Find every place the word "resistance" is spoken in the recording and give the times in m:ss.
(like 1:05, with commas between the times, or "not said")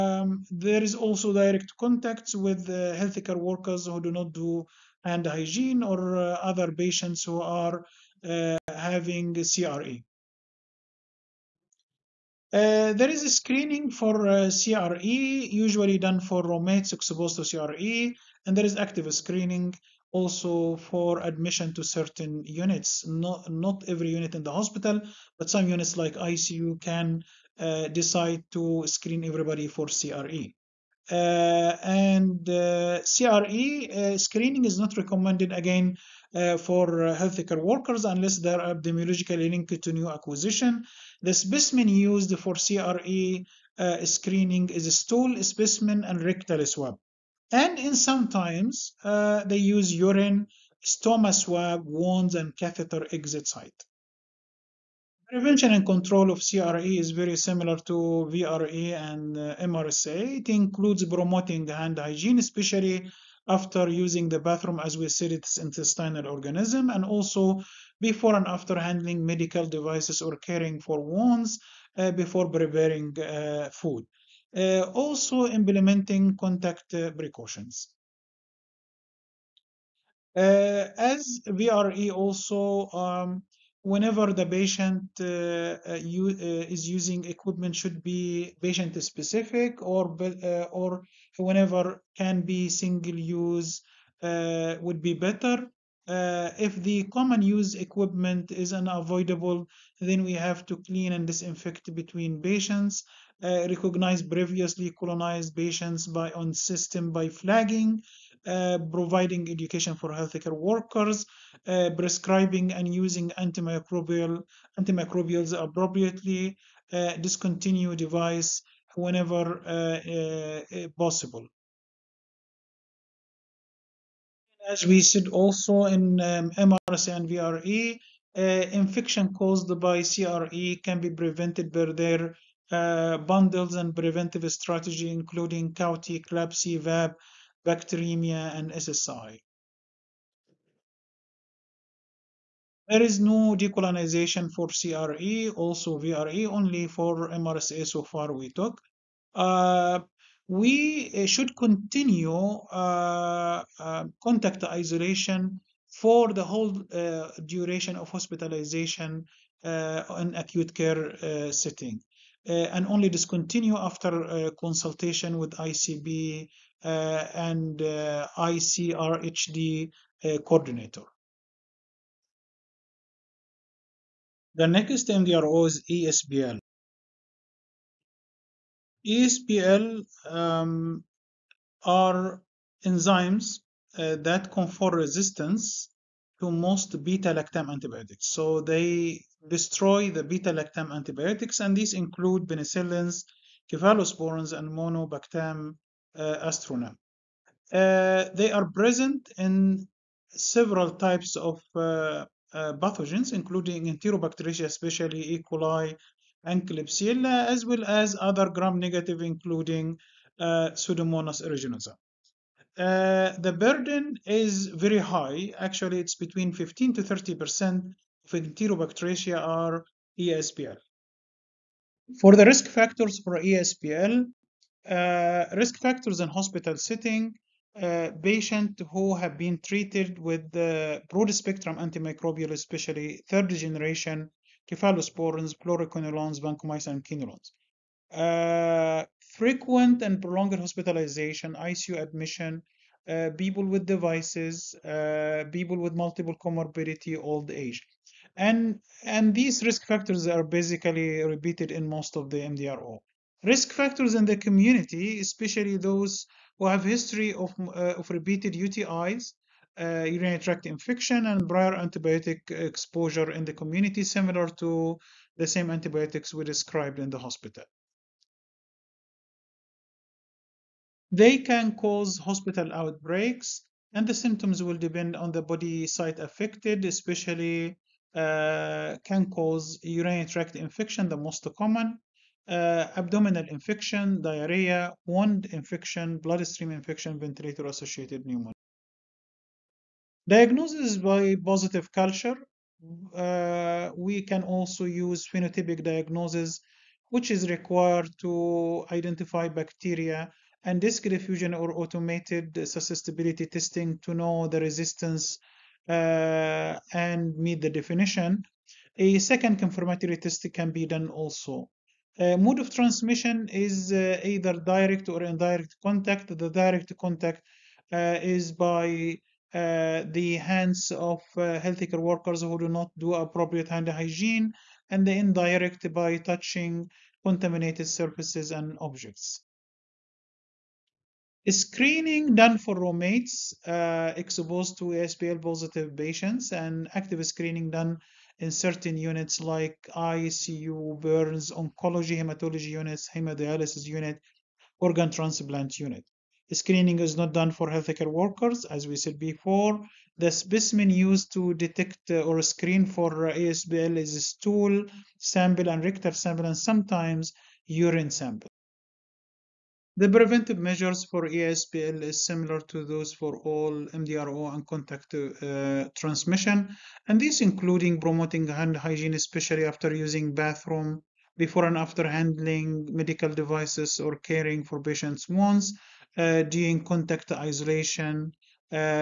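3:04, 5:04.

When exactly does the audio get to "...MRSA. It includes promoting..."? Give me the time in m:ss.
0:59.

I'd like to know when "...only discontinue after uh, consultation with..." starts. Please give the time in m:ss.
2:42.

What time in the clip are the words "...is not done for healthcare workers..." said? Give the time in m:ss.
5:46.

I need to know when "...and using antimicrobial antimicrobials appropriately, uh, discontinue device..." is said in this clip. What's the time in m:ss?
1:52.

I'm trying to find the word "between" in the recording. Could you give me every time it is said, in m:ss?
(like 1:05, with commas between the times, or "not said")
1:41, 3:36.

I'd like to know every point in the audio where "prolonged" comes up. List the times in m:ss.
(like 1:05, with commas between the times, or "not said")
4:00.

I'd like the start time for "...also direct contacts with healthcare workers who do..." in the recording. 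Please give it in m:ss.
0:00.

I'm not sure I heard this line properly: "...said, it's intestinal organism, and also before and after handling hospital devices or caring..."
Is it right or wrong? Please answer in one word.
wrong.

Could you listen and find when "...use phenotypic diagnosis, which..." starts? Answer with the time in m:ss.
4:54.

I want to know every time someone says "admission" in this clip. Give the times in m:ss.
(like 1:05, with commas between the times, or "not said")
0:21, 4:01.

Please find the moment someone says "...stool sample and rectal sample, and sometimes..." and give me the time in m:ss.
5:54.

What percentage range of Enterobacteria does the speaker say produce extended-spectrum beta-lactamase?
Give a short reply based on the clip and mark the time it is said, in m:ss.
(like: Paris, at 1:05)
15 to 30 percent, at 3:36.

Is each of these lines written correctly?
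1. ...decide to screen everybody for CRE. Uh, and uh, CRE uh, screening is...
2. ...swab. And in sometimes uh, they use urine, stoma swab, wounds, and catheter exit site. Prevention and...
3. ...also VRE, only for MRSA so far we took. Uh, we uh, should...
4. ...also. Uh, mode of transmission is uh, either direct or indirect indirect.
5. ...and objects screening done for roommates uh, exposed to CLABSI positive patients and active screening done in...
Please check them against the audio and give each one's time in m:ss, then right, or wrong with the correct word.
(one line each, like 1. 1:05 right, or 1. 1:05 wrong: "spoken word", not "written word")
1. 0:27 right
2. 0:46 right
3. 2:25 right
4. 5:11 wrong: "contact", not "indirect"
5. 5:28 wrong: "ASPL", not "CLABSI".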